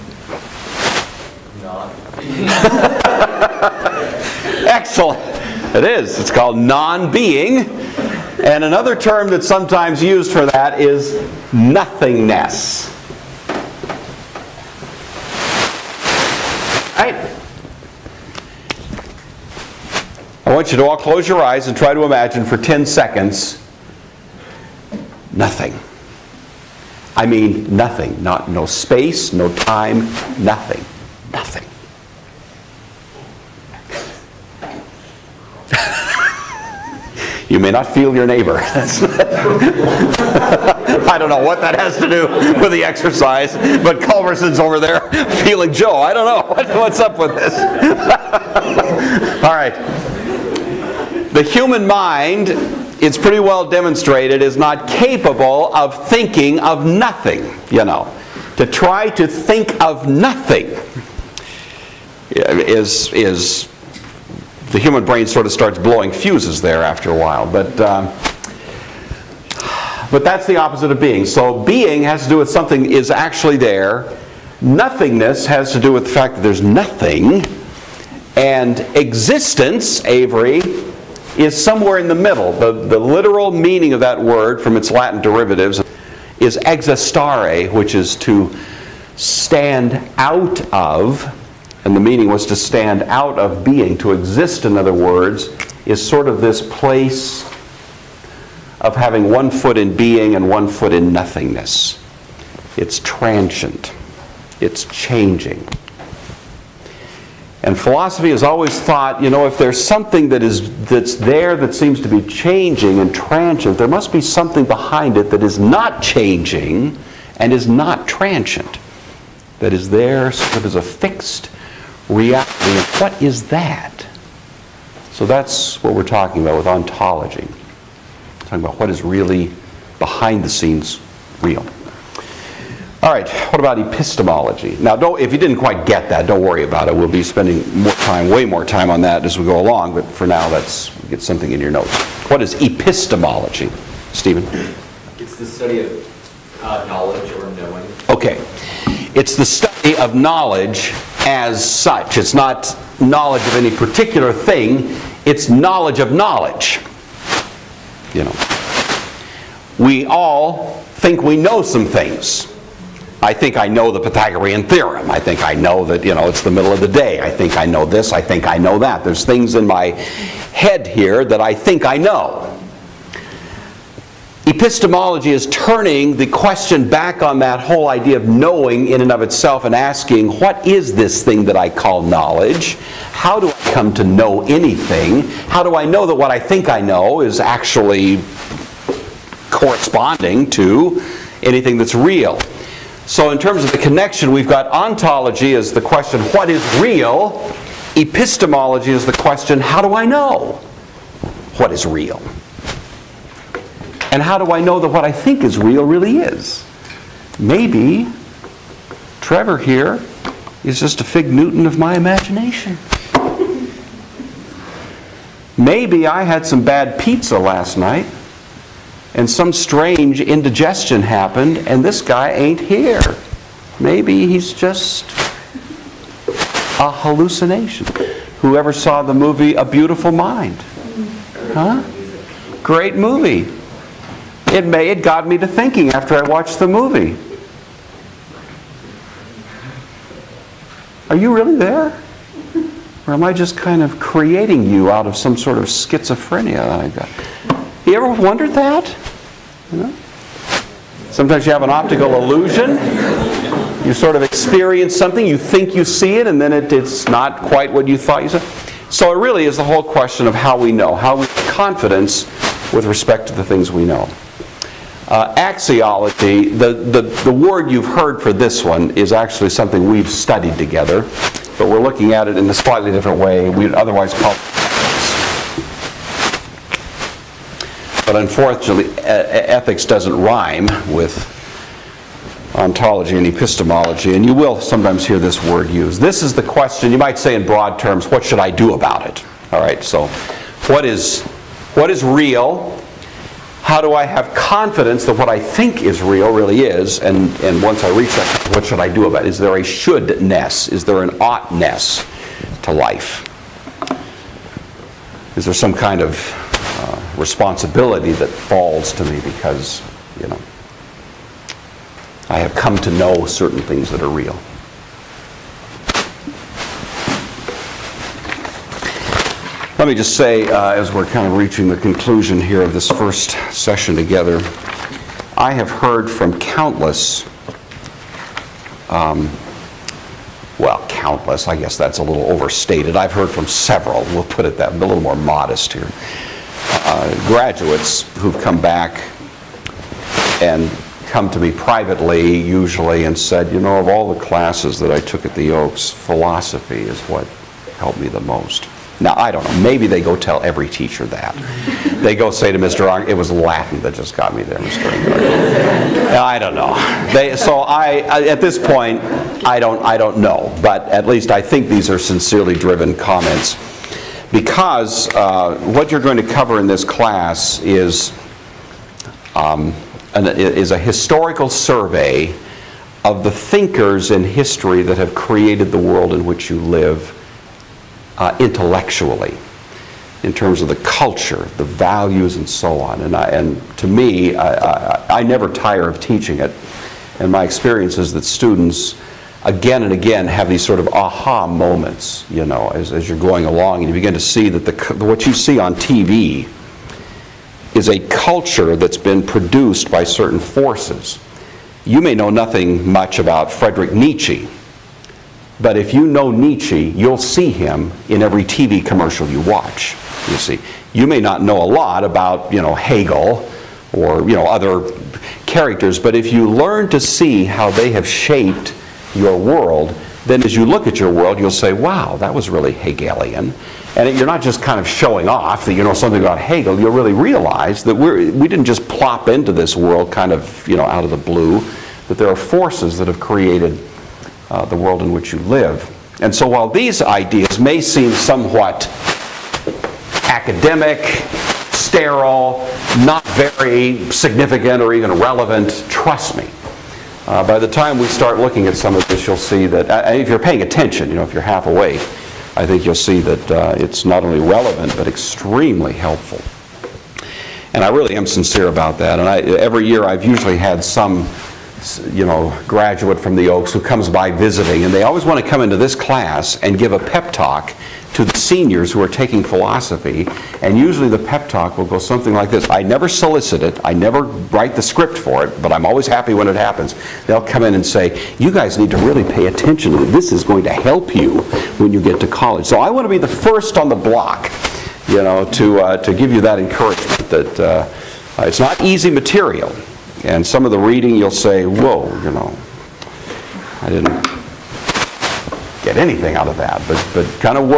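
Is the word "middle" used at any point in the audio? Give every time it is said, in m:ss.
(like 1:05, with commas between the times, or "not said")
1:22, 2:46.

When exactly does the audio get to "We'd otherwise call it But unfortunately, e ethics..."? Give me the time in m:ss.
4:33.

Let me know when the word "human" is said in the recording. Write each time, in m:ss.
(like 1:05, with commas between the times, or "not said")
0:51, 1:04.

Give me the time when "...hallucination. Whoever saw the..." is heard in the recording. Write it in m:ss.
3:46.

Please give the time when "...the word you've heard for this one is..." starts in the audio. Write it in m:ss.
4:27.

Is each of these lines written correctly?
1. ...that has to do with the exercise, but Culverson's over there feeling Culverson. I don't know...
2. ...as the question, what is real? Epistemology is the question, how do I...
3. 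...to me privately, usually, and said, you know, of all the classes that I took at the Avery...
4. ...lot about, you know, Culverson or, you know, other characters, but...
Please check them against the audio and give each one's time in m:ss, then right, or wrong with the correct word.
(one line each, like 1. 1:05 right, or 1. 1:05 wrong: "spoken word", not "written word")
1. 0:41 wrong: "Joe", not "Culverson"
2. 3:15 right
3. 5:41 wrong: "Oaks", not "Avery"
4. 6:51 wrong: "Hegel", not "Culverson".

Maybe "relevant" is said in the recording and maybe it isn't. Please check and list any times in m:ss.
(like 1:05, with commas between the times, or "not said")
7:25, 7:34.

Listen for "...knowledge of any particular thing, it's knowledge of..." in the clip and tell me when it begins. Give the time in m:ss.
2:33.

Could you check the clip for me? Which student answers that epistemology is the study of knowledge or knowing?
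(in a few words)
Stephen.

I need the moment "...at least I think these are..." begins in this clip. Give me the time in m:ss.
6:00.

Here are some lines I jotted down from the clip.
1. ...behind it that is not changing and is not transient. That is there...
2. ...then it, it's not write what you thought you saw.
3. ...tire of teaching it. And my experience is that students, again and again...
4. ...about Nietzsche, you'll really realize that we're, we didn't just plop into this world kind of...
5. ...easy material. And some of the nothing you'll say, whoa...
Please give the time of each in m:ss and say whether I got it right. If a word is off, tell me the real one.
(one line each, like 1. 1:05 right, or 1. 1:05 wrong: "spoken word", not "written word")
1. 1:54 right
2. 4:16 wrong: "quite", not "write"
3. 6:25 right
4. 7:06 wrong: "Hegel", not "Nietzsche"
5. 8:08 wrong: "reading", not "nothing".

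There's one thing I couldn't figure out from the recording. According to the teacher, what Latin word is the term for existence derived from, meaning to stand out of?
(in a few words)
existare.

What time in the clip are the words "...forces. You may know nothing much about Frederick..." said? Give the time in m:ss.
6:40.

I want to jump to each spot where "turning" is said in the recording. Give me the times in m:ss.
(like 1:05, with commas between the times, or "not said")
2:55.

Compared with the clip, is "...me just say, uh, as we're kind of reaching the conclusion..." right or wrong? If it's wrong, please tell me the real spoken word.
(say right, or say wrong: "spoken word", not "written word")
right.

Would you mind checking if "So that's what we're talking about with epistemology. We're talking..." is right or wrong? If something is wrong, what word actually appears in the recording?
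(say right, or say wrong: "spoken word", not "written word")
wrong: "ontology", not "epistemology".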